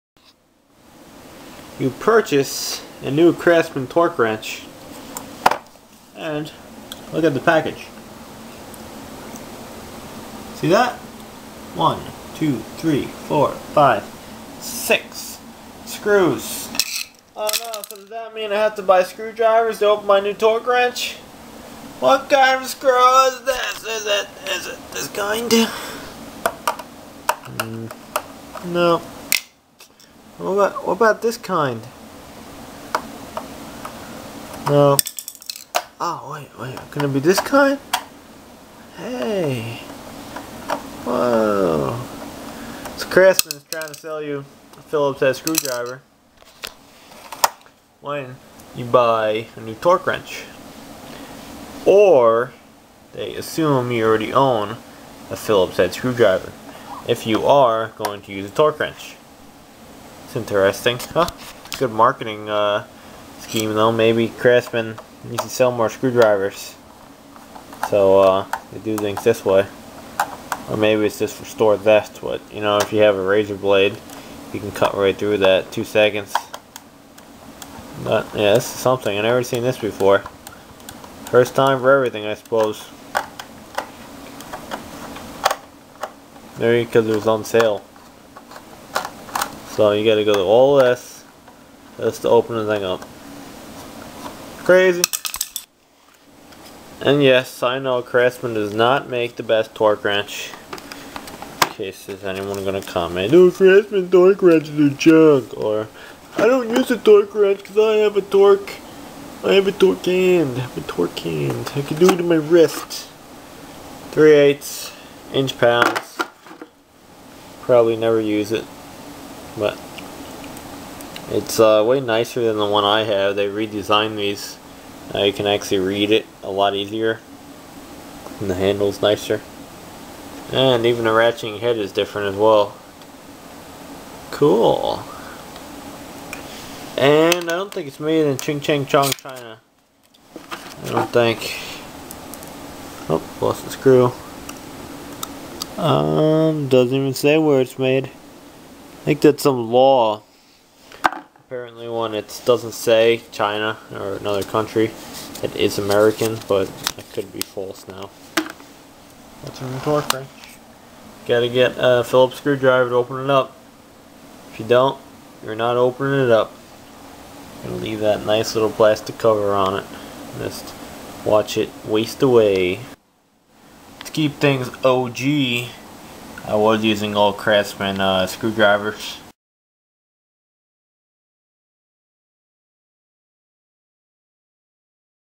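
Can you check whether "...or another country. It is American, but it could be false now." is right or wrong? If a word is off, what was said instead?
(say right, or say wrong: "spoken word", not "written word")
right.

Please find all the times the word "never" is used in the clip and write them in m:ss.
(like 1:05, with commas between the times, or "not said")
1:19, 1:57.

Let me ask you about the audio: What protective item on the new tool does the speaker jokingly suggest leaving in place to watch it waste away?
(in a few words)
plastic cover.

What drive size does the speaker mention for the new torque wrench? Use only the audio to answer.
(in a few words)
3/8.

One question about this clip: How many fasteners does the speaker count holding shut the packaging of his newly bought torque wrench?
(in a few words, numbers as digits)
6.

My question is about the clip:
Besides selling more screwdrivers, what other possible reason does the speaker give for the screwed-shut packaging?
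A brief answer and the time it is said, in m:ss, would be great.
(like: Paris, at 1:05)
store theft, at 1:11.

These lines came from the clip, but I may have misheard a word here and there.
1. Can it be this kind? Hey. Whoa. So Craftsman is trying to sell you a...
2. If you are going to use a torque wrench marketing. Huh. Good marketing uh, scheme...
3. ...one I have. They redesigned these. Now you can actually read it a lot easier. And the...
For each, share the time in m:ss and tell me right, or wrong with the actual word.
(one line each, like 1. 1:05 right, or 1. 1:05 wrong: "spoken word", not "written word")
1. 0:36 right
2. 0:57 wrong: "interesting", not "marketing"
3. 2:02 right.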